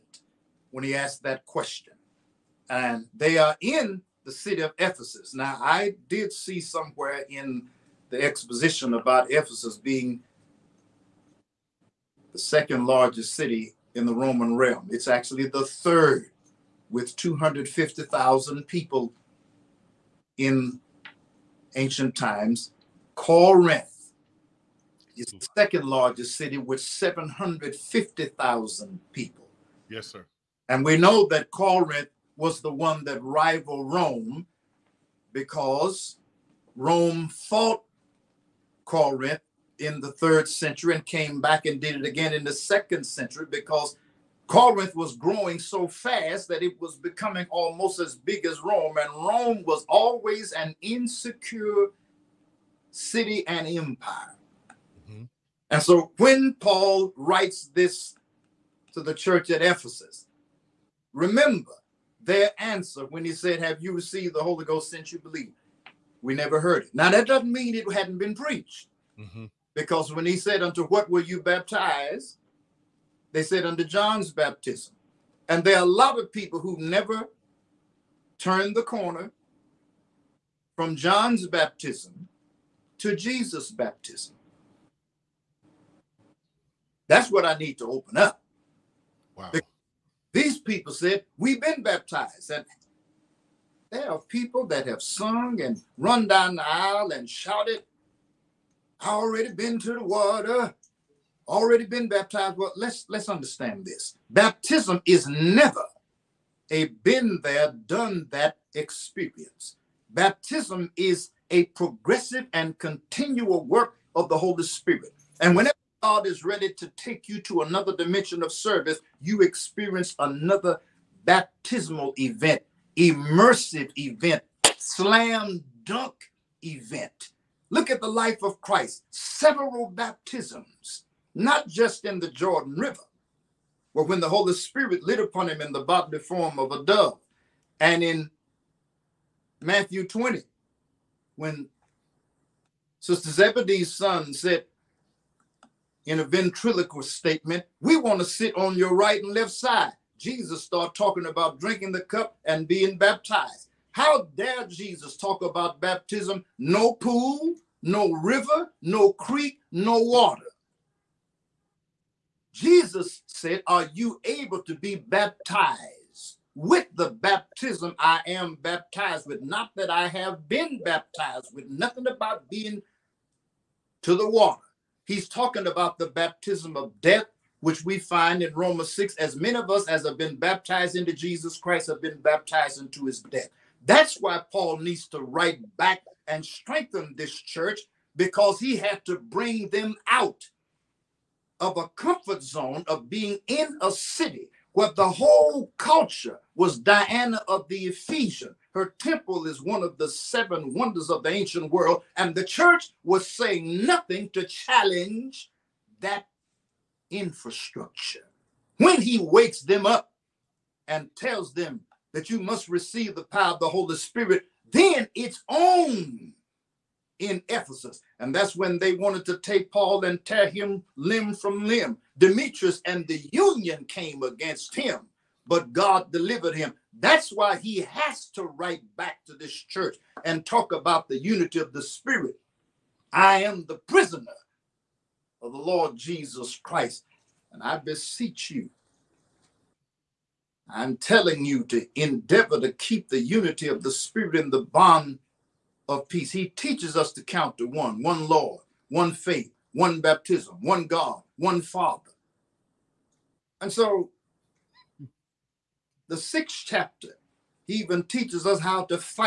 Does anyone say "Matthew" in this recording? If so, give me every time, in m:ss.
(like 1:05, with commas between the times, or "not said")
2:19.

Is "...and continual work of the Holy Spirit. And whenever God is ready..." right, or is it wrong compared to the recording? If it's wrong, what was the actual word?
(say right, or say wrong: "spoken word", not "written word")
right.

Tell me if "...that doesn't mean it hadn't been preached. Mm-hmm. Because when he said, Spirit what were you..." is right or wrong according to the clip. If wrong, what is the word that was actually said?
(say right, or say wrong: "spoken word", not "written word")
wrong: "Unto", not "Spirit".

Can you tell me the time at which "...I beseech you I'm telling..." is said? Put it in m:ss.
3:57.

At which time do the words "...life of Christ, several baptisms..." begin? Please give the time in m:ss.
2:08.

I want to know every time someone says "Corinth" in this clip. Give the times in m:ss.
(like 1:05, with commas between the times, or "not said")
0:23, 0:31, 0:38, 0:44.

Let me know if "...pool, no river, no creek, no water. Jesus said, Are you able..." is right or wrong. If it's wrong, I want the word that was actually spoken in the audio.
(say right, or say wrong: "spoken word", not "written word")
right.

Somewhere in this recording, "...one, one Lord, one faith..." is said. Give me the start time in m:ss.
4:07.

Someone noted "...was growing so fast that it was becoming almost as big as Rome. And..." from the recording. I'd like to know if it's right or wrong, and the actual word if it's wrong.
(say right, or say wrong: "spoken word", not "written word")
right.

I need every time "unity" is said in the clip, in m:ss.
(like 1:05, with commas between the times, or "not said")
3:51, 4:03.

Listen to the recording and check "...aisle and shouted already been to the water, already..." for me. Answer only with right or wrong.
right.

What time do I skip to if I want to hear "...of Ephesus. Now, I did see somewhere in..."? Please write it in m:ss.
0:04.